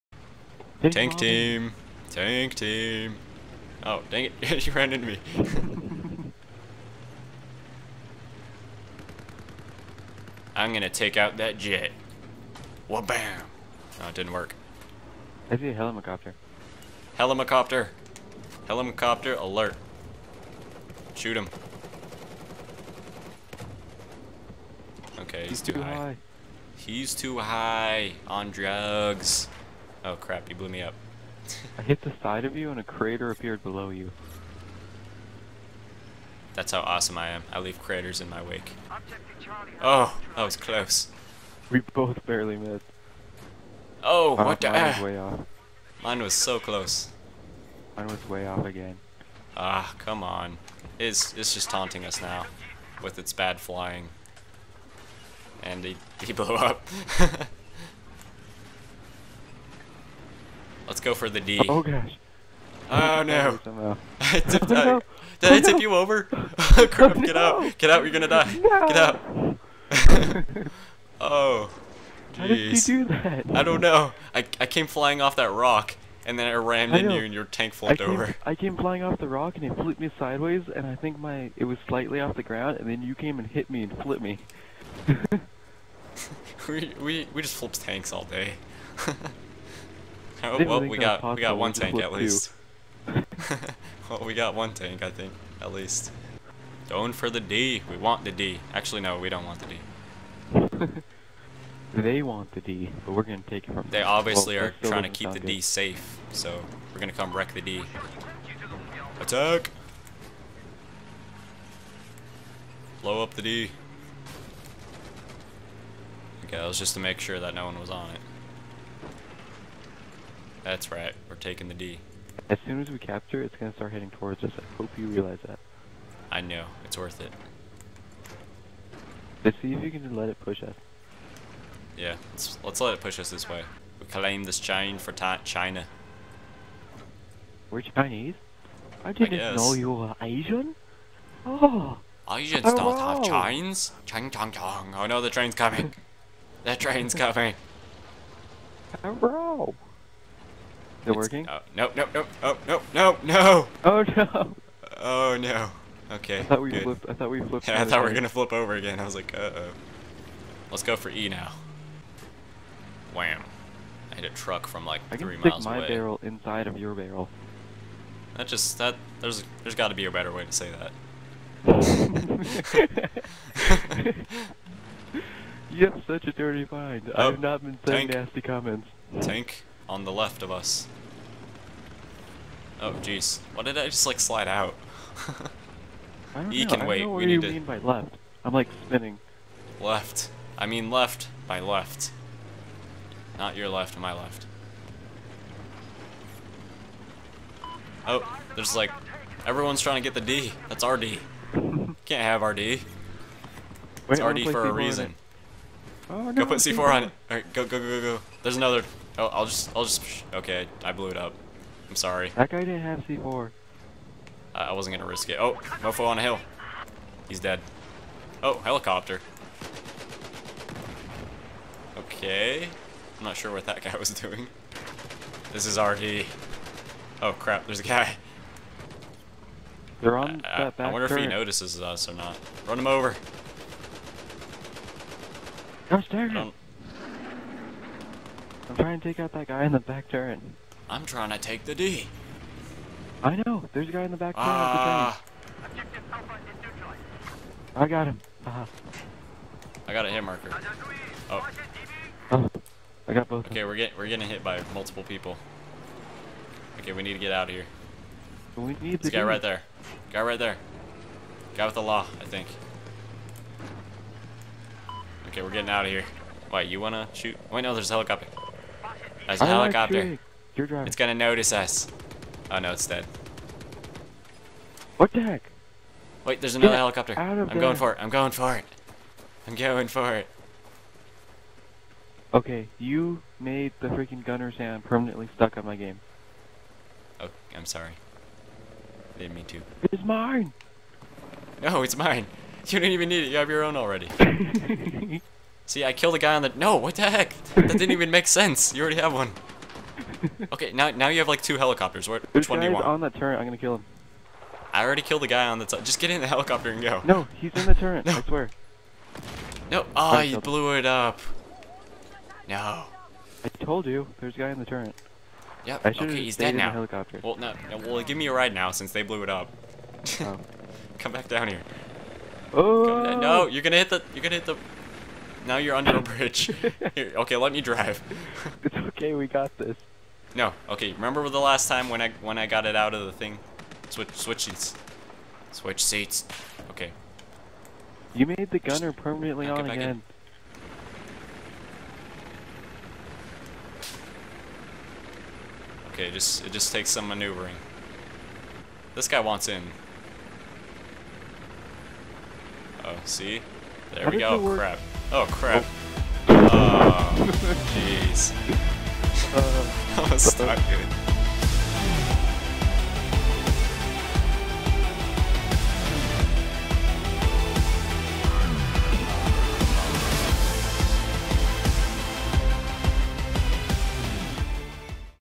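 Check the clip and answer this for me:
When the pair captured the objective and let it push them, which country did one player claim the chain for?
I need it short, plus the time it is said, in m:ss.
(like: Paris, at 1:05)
China, at 2:15.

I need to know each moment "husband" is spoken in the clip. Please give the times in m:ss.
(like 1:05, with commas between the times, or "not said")
not said.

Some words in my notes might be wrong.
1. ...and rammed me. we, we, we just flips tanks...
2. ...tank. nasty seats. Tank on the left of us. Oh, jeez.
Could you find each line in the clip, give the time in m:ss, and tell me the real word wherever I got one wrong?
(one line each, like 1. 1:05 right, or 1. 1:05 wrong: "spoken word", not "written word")
1. 1:23 wrong: "flipped", not "rammed"
2. 2:58 wrong: "comments", not "seats".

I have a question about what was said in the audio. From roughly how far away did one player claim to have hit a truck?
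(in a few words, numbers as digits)
3 miles.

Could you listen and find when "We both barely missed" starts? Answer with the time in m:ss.
0:41.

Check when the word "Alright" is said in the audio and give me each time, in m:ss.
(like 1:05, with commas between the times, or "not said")
3:27.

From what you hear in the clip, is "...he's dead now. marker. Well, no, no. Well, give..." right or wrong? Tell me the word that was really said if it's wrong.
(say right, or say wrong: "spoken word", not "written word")
wrong: "helicopter", not "marker".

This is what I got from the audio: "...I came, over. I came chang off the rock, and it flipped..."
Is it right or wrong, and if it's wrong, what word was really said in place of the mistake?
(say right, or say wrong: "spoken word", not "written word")
wrong: "flying", not "chang".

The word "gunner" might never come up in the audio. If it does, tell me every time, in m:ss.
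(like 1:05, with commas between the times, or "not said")
4:44, 5:38.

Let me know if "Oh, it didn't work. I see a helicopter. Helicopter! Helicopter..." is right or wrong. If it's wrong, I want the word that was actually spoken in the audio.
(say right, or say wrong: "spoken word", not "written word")
right.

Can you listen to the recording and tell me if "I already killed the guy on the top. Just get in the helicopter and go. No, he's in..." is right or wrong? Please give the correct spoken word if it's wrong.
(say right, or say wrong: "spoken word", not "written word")
right.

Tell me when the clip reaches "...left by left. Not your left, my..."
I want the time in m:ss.
3:10.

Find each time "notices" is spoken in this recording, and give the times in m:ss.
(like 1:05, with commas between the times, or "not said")
3:51, 4:31.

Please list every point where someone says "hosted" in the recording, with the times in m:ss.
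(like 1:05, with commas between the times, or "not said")
not said.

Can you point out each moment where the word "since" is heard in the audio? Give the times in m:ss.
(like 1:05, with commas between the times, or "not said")
5:18.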